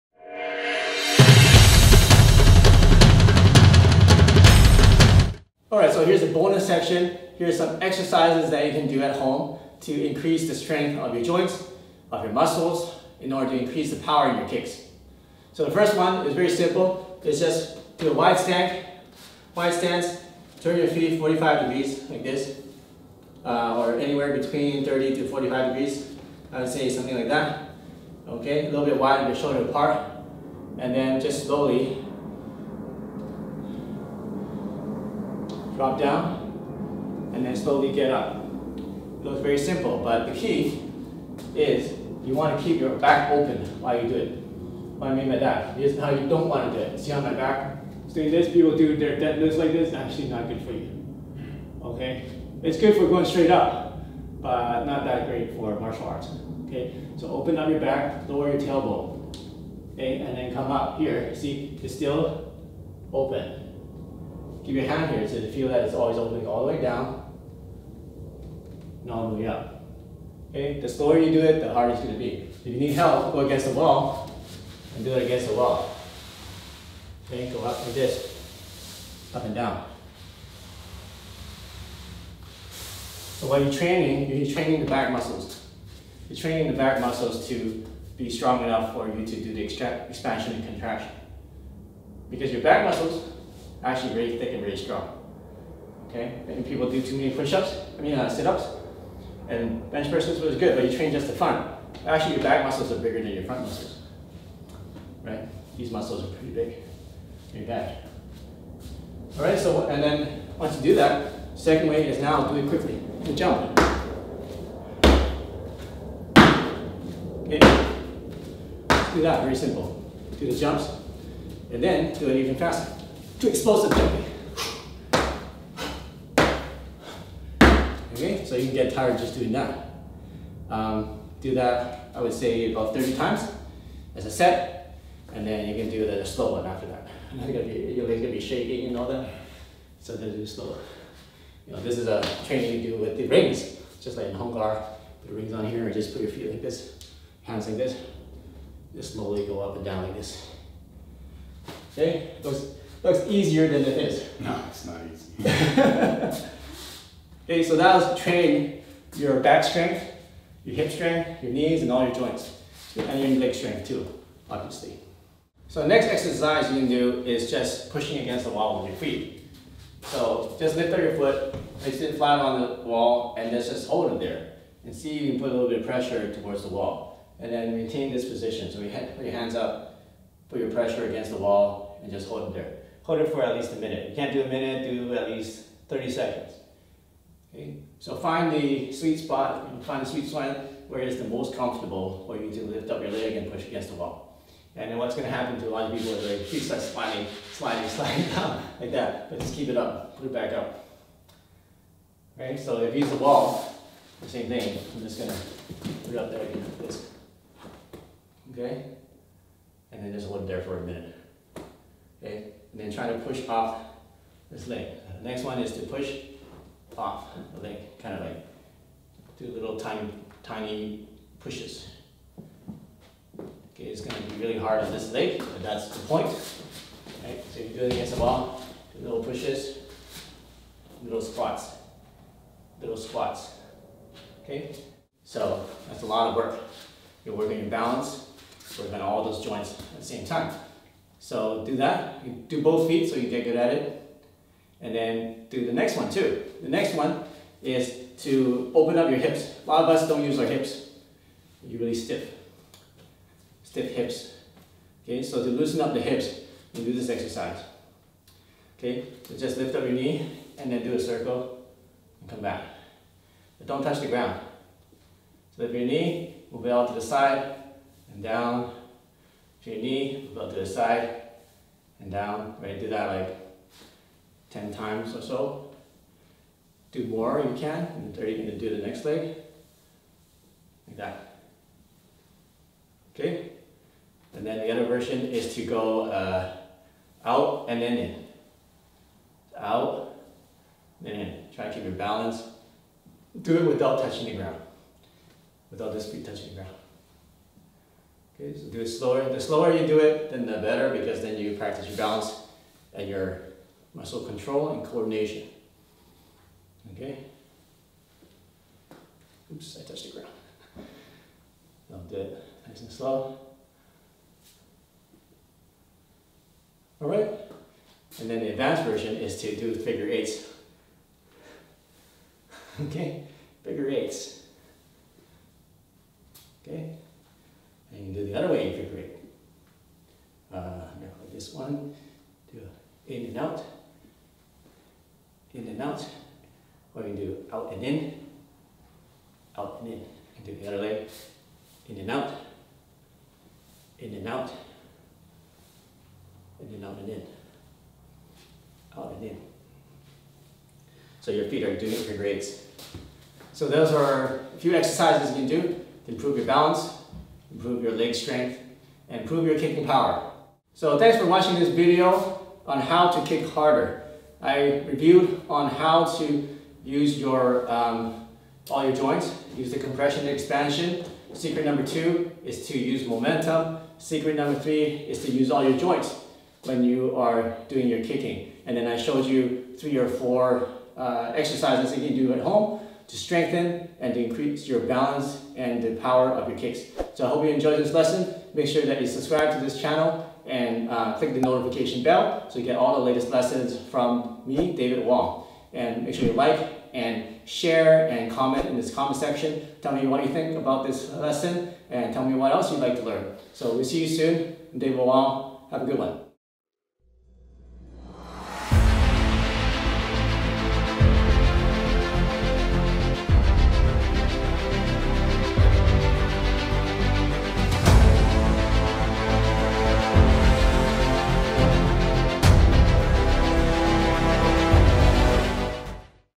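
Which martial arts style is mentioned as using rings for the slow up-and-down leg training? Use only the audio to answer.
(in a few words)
Hung Gar.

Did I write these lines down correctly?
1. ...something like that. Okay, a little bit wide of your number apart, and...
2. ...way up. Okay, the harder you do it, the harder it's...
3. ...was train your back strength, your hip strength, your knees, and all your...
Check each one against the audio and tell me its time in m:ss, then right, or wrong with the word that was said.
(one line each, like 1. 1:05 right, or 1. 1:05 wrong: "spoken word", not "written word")
1. 0:26 wrong: "shoulder", not "number"
2. 1:09 wrong: "slower", not "harder"
3. 2:37 right.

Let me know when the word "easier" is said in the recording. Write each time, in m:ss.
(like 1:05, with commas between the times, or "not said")
2:33.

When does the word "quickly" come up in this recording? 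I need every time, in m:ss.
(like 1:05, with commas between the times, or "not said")
1:52.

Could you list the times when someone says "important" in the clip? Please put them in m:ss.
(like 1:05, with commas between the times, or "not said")
not said.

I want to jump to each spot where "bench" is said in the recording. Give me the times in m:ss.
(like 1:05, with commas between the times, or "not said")
1:39.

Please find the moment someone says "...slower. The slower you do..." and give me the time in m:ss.
4:58.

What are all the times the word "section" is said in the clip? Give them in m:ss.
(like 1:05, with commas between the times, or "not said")
0:06, 6:39.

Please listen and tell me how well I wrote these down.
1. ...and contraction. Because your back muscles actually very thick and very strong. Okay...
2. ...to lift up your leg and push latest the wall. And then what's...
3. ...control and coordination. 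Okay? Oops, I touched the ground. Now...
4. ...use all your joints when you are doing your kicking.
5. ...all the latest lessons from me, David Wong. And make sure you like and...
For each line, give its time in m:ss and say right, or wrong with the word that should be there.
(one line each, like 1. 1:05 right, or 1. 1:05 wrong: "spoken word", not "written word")
1. 1:30 right
2. 3:12 wrong: "against", not "latest"
3. 5:04 right
4. 6:15 right
5. 6:32 right.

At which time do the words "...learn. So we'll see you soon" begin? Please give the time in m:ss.
6:43.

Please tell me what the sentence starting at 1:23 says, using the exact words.
So while you're training, you're training the back muscles.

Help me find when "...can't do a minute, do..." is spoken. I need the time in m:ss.
3:04.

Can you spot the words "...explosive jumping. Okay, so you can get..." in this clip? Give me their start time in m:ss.
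2:03.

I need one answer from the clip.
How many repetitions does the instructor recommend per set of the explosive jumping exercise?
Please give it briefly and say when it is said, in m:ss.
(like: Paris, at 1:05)
30, at 2:12.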